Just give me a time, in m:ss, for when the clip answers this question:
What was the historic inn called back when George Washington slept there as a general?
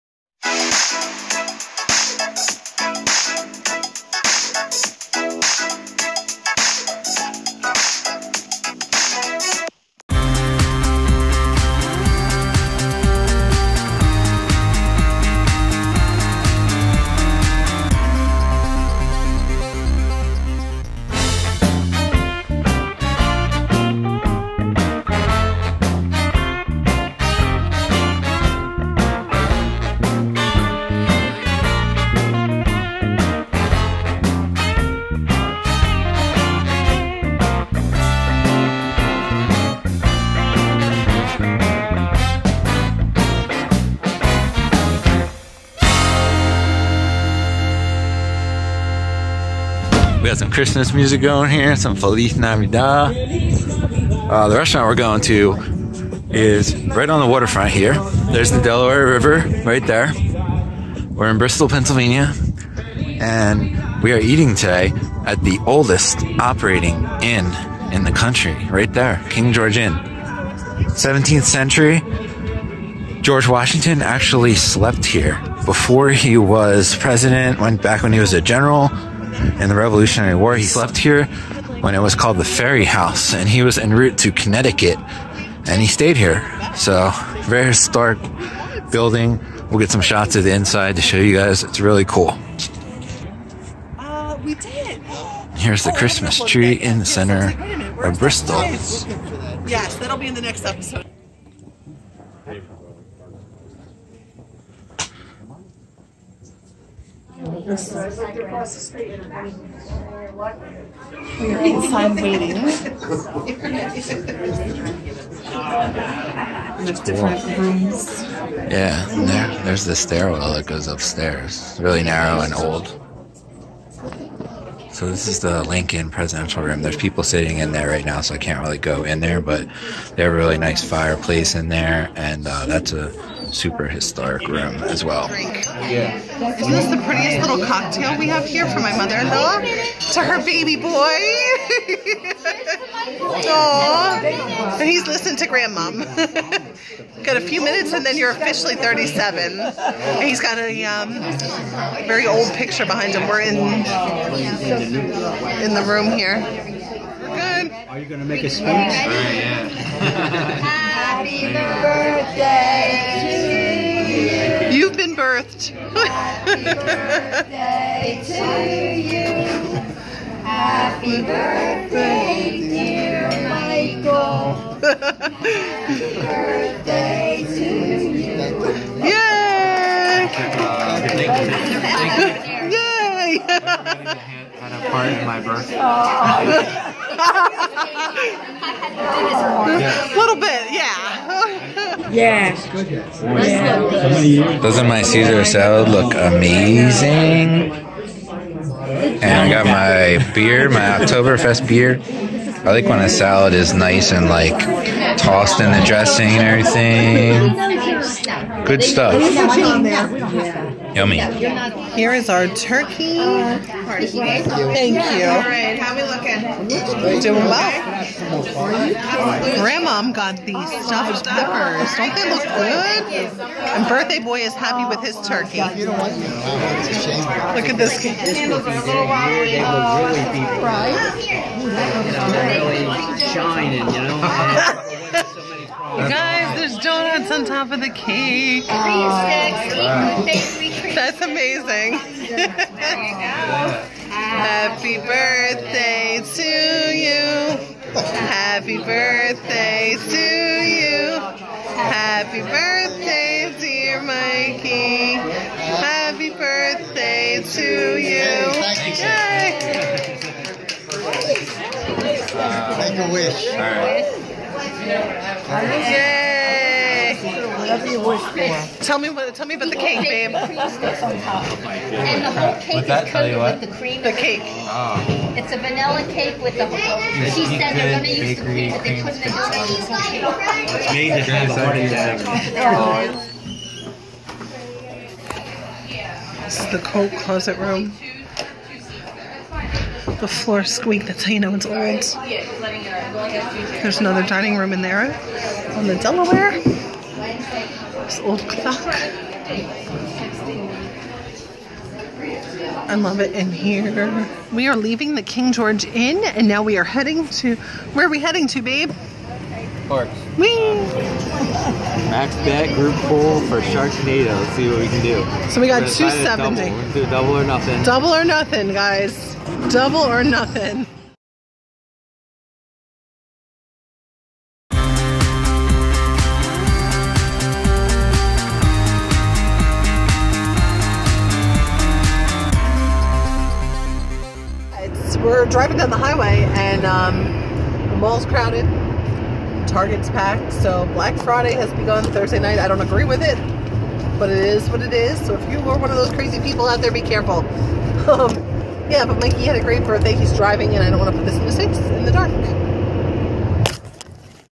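1:22.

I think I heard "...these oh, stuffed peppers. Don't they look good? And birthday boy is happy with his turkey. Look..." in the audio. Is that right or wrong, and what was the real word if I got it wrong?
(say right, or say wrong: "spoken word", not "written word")
right.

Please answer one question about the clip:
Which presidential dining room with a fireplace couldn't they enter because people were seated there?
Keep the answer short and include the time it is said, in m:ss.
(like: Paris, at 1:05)
Lincoln Presidential Room, at 2:05.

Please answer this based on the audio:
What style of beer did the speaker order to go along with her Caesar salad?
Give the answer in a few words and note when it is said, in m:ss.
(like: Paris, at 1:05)
Oktoberfest, at 3:20.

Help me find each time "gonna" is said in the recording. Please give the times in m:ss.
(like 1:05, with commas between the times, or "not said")
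4:37, 5:16.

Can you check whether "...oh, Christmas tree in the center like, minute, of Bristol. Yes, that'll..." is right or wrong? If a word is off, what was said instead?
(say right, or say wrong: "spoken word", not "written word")
right.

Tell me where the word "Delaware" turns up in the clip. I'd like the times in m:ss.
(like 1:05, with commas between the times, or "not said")
0:58, 4:56.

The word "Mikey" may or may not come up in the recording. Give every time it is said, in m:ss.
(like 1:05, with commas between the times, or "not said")
4:14, 5:49.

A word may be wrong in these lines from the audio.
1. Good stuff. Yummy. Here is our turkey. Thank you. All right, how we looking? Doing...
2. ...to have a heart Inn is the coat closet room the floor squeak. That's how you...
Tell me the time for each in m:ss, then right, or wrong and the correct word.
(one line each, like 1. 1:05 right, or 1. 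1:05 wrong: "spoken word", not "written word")
1. 3:28 right
2. 4:41 wrong: "This", not "Inn".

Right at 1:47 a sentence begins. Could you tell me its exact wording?
across the street We are inside waiting.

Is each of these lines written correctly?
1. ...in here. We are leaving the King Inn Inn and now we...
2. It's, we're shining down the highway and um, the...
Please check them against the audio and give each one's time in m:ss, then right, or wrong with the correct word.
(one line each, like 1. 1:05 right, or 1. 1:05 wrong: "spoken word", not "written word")
1. 5:03 wrong: "George", not "Inn"
2. 5:34 wrong: "driving", not "shining".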